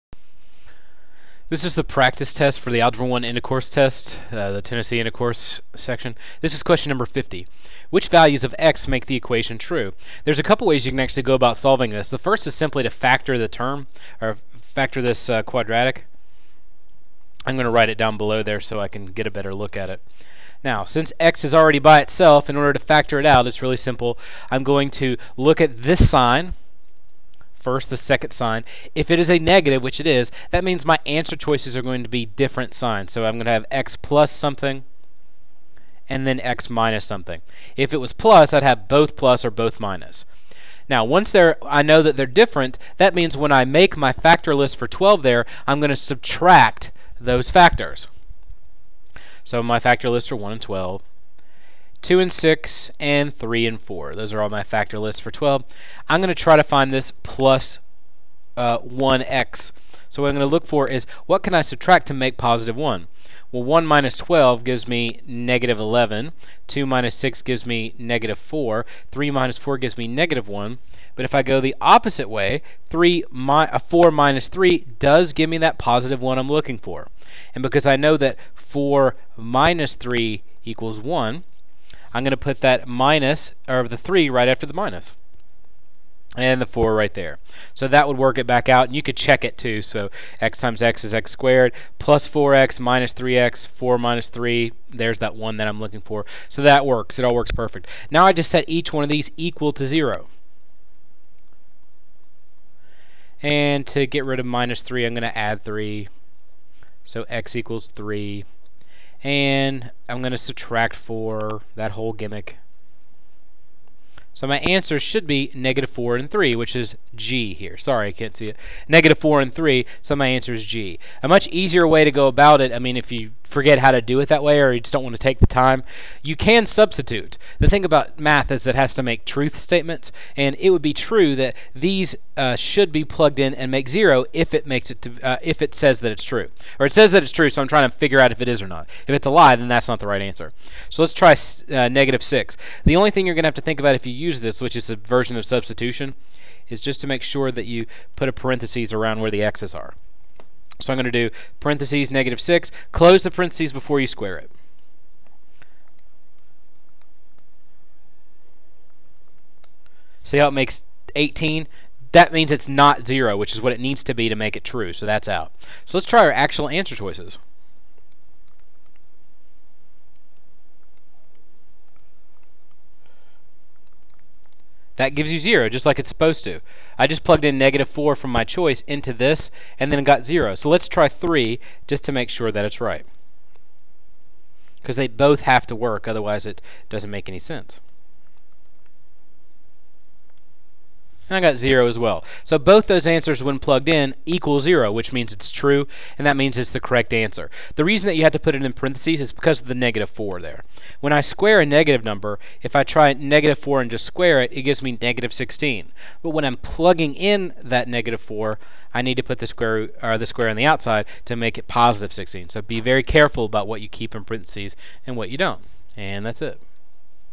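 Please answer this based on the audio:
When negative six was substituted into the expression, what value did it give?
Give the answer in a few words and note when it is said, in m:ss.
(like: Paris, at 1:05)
18, at 2:41.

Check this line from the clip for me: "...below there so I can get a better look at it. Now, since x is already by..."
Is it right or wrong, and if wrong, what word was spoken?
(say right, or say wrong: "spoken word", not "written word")
right.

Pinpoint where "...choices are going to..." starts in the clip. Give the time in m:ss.
0:31.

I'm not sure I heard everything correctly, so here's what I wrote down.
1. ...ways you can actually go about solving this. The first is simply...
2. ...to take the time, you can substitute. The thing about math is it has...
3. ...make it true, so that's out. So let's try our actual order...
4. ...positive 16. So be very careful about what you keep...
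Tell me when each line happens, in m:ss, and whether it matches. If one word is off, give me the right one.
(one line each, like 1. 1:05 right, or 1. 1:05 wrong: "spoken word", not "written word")
1. 0:10 right
2. 2:05 right
3. 2:44 wrong: "answer", not "order"
4. 3:31 right.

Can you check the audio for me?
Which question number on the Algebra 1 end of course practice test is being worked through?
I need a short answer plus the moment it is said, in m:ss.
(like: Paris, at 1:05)
50, at 0:07.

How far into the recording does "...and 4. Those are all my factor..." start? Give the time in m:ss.
0:53.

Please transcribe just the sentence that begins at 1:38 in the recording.
Now I just set each one of these equal to 0.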